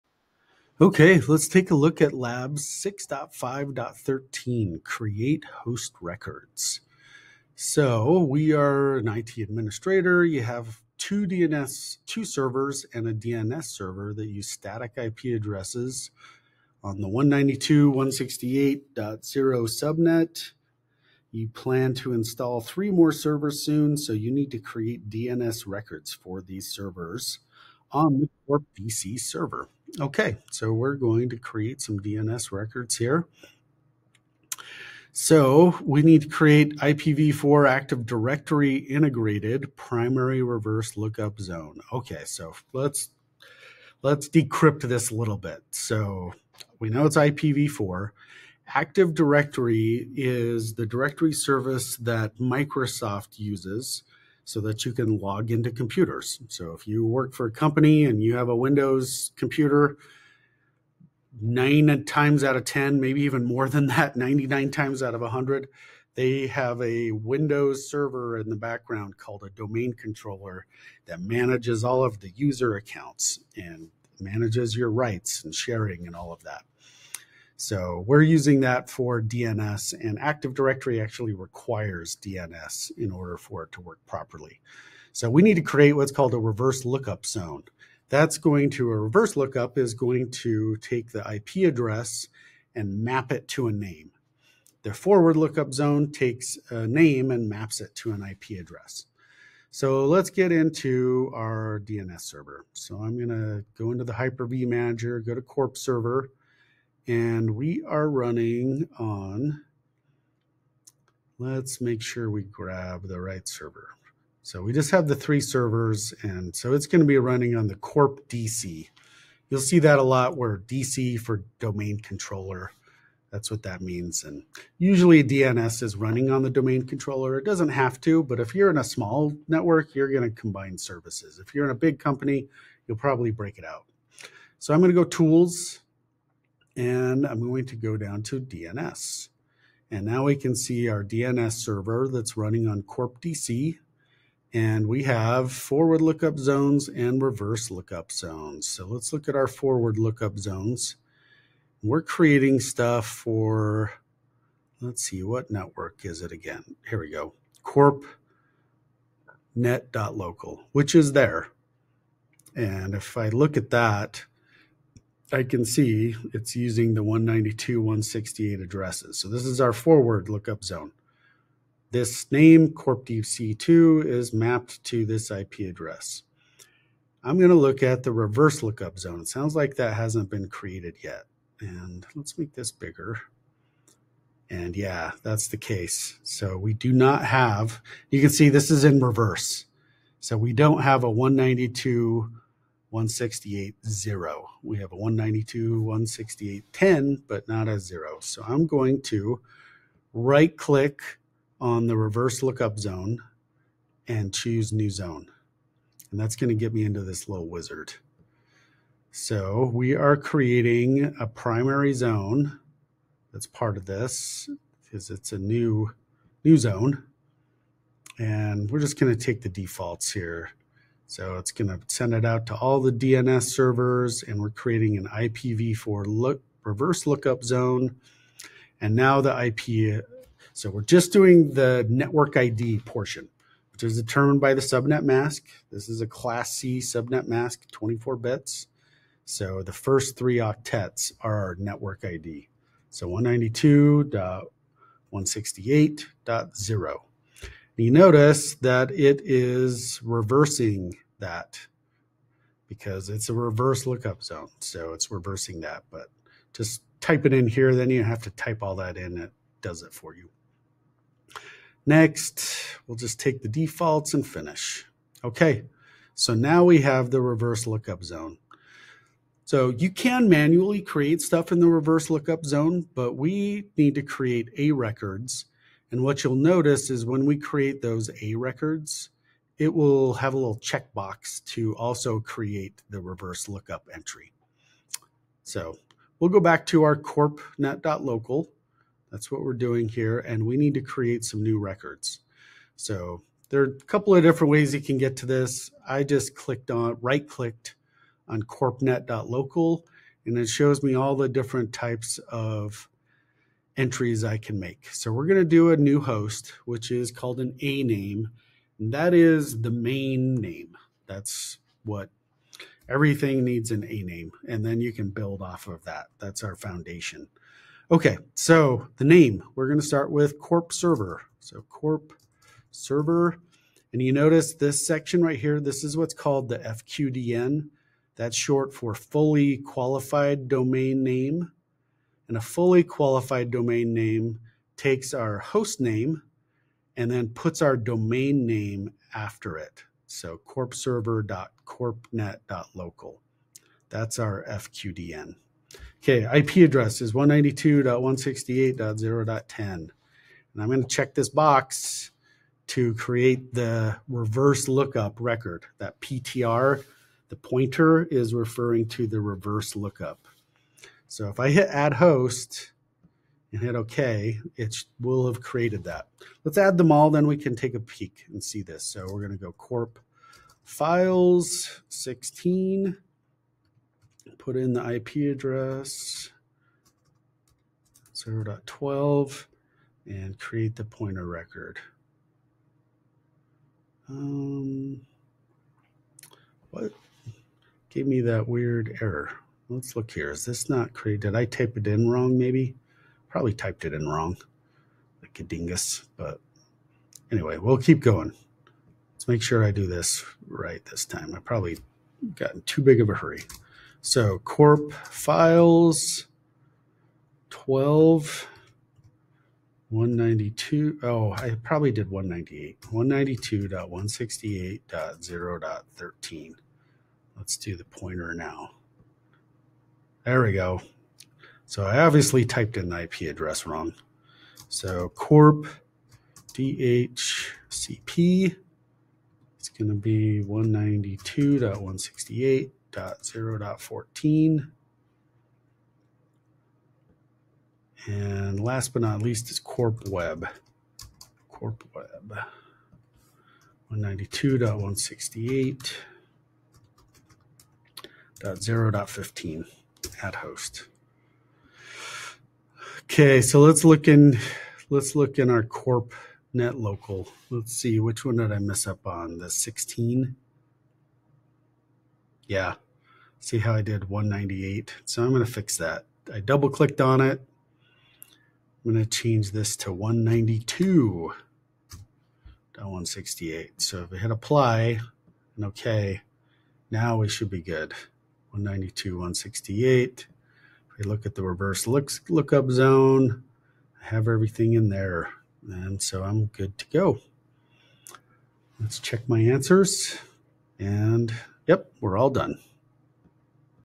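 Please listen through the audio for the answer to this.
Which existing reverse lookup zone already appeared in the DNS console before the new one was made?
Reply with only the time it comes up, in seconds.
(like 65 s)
194 s.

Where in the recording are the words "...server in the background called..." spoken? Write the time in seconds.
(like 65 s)
67 s.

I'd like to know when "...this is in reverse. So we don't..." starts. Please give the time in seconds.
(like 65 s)
188 s.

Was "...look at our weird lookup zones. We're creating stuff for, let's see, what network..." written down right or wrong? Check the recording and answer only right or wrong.
wrong.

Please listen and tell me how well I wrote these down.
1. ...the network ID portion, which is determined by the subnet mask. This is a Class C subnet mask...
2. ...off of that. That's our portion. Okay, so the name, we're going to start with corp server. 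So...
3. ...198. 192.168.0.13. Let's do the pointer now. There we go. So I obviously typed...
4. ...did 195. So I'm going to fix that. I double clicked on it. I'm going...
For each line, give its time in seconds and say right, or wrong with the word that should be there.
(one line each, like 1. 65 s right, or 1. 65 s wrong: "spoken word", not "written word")
1. 231 s right
2. 315 s wrong: "foundation", not "portion"
3. 412 s right
4. 463 s wrong: "198", not "195".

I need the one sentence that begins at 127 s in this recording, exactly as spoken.
It doesn't have to, but if you're in a small network, you're going to combine services.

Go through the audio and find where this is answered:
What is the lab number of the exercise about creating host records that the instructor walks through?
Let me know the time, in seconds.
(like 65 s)
2 s.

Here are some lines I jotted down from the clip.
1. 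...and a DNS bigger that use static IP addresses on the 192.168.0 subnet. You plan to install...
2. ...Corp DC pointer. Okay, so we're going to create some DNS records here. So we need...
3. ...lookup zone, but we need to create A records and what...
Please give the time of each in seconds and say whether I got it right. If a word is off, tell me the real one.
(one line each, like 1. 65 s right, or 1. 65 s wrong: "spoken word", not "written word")
1. 12 s wrong: "server", not "bigger"
2. 28 s wrong: "server", not "pointer"
3. 272 s right.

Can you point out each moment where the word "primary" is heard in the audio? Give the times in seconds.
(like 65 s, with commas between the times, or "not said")
39 s, 211 s.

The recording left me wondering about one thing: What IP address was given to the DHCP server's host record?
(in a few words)
192.168.0.14.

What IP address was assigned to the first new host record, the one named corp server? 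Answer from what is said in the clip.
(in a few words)
192.168.0.10.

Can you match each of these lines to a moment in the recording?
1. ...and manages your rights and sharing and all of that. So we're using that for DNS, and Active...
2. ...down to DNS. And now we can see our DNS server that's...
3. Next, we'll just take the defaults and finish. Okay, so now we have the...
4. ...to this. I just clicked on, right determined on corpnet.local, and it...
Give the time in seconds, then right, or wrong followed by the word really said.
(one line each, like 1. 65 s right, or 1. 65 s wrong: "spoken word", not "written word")
1. 73 s right
2. 137 s right
3. 261 s right
4. 295 s wrong: "clicked", not "determined".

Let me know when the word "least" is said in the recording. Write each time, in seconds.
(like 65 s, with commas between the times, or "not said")
439 s.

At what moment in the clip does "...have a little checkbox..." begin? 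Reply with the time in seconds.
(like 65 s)
280 s.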